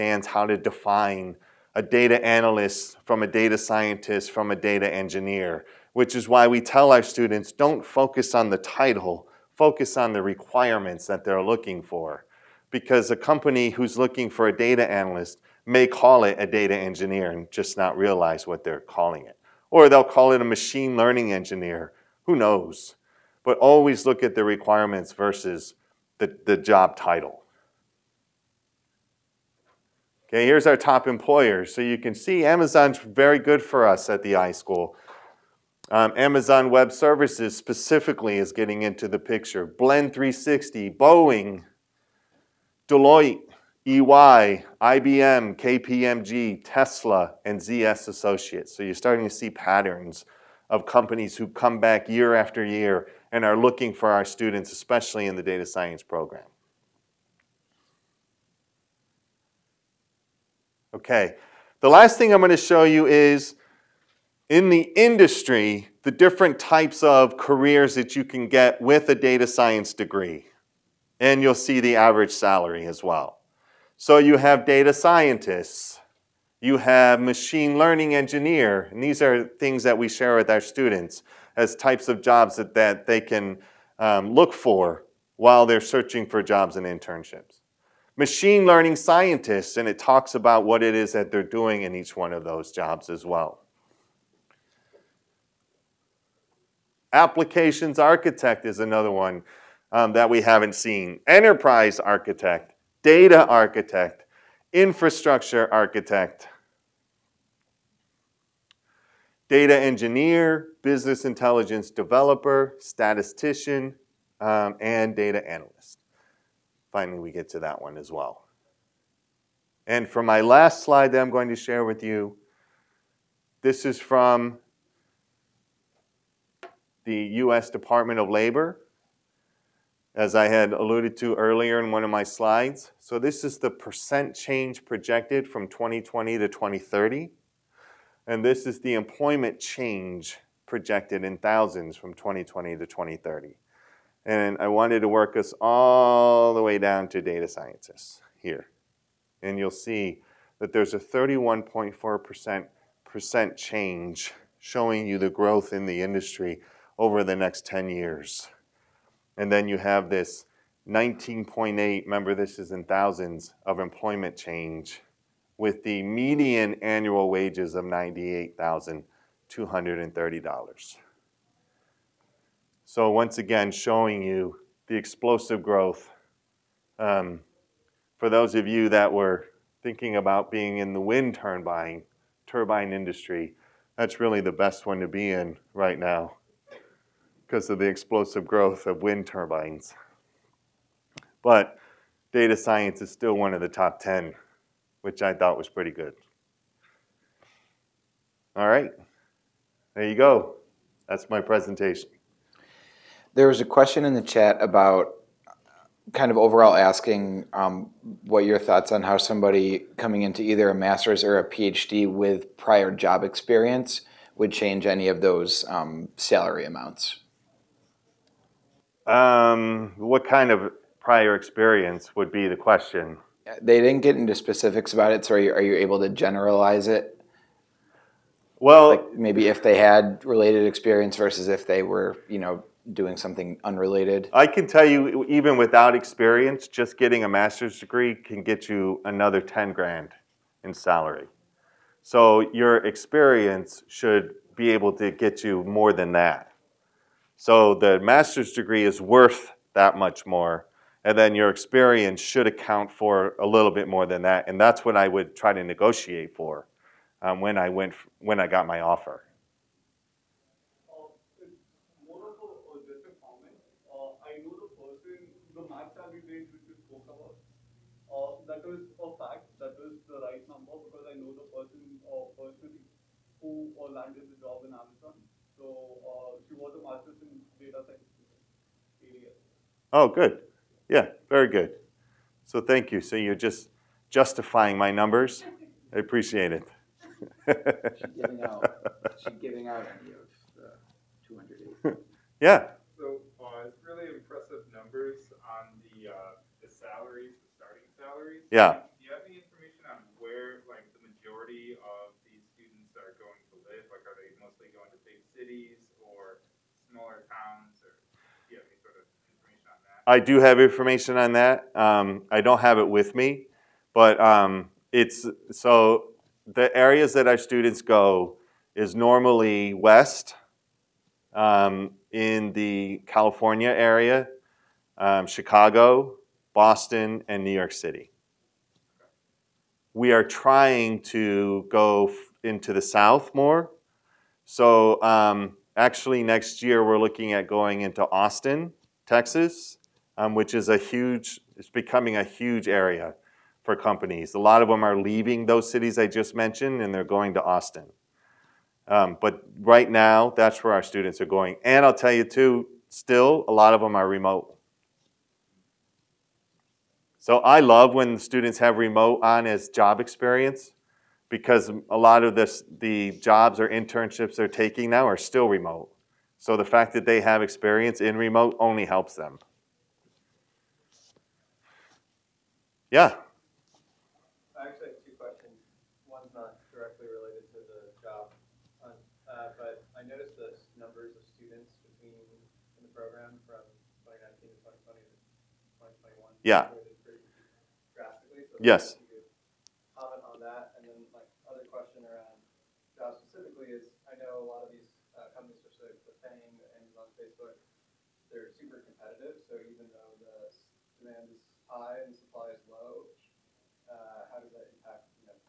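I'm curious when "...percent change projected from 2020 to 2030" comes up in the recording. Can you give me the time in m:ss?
2:13.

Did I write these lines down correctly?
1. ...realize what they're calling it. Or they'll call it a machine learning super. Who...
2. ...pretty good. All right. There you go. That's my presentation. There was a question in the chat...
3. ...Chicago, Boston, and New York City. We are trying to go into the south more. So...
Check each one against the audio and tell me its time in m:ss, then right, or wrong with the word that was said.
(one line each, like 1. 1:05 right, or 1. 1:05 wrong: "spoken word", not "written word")
1. 0:17 wrong: "engineer", not "super"
2. 3:15 right
3. 5:25 right.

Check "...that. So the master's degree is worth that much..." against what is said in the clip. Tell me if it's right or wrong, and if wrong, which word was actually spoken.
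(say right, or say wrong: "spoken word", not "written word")
right.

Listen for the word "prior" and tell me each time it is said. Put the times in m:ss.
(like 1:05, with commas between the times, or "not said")
3:32, 3:40.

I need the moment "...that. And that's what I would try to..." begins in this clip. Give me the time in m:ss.
4:14.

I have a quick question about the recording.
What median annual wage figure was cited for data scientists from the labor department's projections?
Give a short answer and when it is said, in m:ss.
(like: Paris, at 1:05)
$98,230, at 2:47.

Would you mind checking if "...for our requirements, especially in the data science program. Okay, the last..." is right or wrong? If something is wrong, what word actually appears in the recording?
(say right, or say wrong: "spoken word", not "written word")
wrong: "students", not "requirements".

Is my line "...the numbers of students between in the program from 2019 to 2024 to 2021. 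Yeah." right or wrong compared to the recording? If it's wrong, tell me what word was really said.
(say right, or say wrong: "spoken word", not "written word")
wrong: "2020", not "2024".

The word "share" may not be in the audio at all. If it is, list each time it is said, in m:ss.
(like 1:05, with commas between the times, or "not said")
1:20, 2:01.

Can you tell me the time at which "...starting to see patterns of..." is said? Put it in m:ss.
0:48.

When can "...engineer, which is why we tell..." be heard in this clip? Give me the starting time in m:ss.
0:04.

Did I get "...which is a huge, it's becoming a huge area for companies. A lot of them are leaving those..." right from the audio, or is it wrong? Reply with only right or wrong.
right.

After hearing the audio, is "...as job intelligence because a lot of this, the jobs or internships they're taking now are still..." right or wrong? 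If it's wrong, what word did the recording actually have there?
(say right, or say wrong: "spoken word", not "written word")
wrong: "experience", not "intelligence".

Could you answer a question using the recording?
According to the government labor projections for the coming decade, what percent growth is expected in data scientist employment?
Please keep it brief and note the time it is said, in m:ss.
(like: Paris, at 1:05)
31.4%, at 2:30.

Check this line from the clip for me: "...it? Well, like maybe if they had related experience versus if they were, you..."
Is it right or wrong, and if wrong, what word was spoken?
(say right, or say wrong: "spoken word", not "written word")
right.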